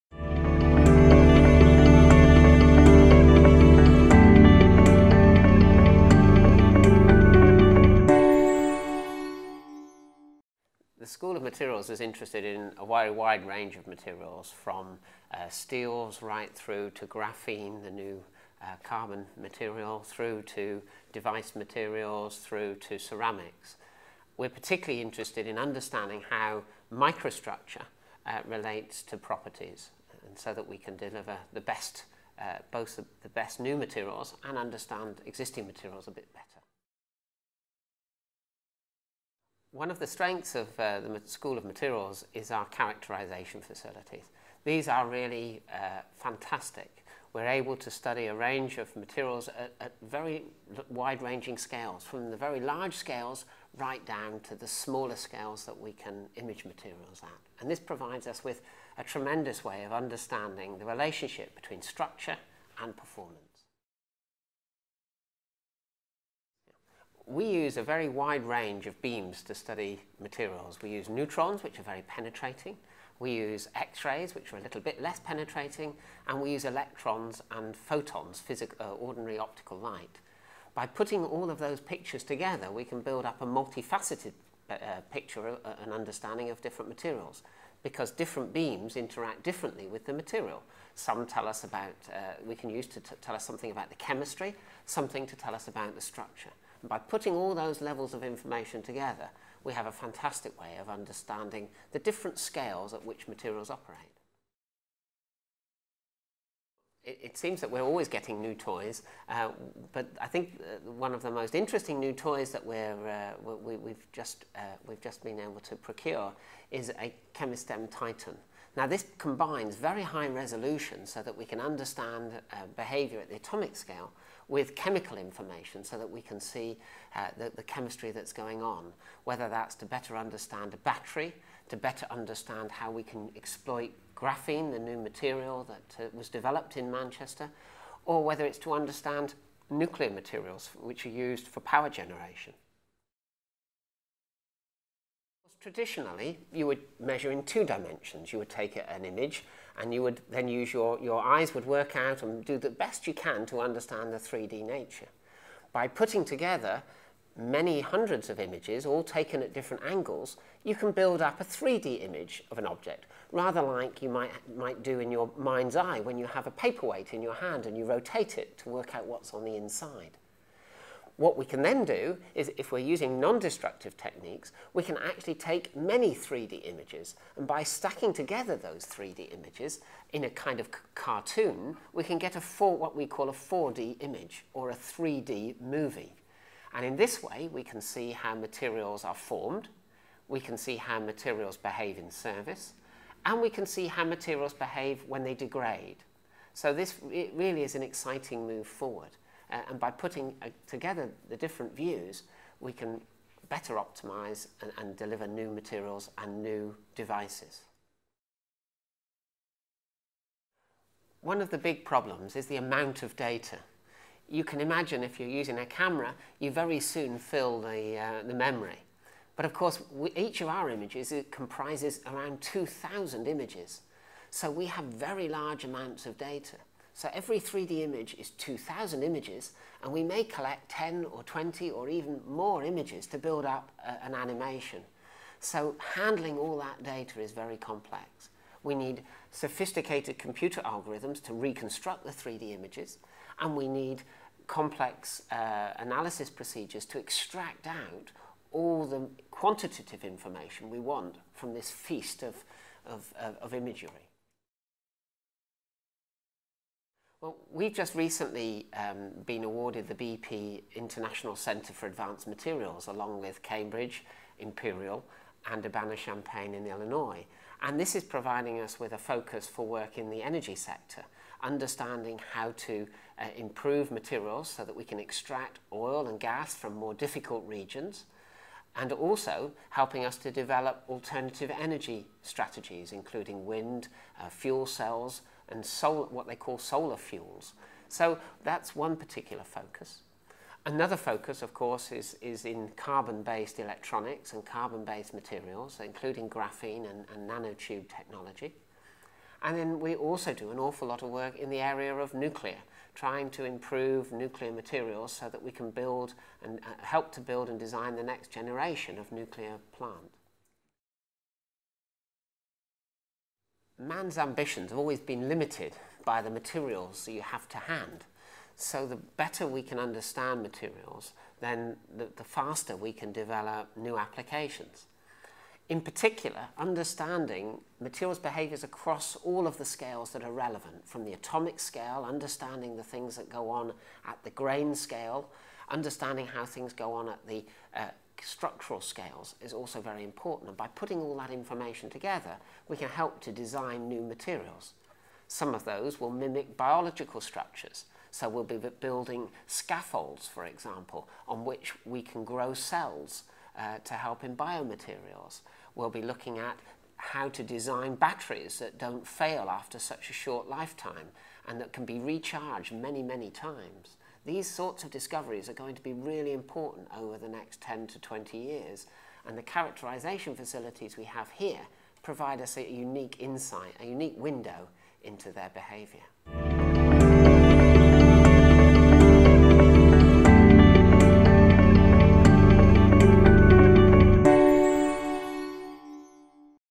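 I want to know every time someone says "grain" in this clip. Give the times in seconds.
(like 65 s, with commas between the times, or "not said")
334 s.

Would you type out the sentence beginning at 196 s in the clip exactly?
So this really is an exciting move forward.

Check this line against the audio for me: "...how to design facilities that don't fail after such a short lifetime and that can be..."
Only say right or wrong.
wrong.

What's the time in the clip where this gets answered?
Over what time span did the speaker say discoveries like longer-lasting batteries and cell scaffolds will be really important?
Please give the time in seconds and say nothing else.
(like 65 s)
367 s.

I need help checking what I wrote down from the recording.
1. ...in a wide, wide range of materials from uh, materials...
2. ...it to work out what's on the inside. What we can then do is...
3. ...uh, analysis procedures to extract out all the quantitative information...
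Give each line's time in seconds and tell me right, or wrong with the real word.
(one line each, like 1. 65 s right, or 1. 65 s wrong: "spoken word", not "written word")
1. 12 s wrong: "steels", not "materials"
2. 168 s right
3. 245 s right.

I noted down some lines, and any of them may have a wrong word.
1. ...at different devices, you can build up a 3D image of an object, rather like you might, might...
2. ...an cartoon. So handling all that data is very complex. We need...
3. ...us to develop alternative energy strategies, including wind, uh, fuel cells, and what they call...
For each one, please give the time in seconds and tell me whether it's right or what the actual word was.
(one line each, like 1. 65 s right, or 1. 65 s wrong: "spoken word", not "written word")
1. 159 s wrong: "angles", not "devices"
2. 234 s wrong: "animation", not "cartoon"
3. 280 s right.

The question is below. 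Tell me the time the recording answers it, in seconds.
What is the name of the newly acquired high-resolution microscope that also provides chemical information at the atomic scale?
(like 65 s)
117 s.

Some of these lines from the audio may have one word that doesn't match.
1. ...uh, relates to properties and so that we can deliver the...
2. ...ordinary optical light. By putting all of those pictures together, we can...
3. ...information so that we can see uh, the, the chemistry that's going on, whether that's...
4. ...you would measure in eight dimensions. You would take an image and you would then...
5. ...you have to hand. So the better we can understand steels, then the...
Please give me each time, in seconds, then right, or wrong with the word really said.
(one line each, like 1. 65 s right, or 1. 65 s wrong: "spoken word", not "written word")
1. 28 s right
2. 78 s right
3. 125 s right
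4. 146 s wrong: "two", not "eight"
5. 317 s wrong: "materials", not "steels".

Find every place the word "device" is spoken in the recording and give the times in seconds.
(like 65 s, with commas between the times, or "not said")
21 s, 206 s.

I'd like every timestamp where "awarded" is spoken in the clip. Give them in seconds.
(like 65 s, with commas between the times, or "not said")
259 s.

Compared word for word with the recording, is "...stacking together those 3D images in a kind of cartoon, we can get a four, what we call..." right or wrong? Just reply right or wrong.
right.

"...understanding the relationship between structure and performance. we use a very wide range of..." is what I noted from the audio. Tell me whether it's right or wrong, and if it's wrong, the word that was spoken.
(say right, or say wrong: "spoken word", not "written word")
right.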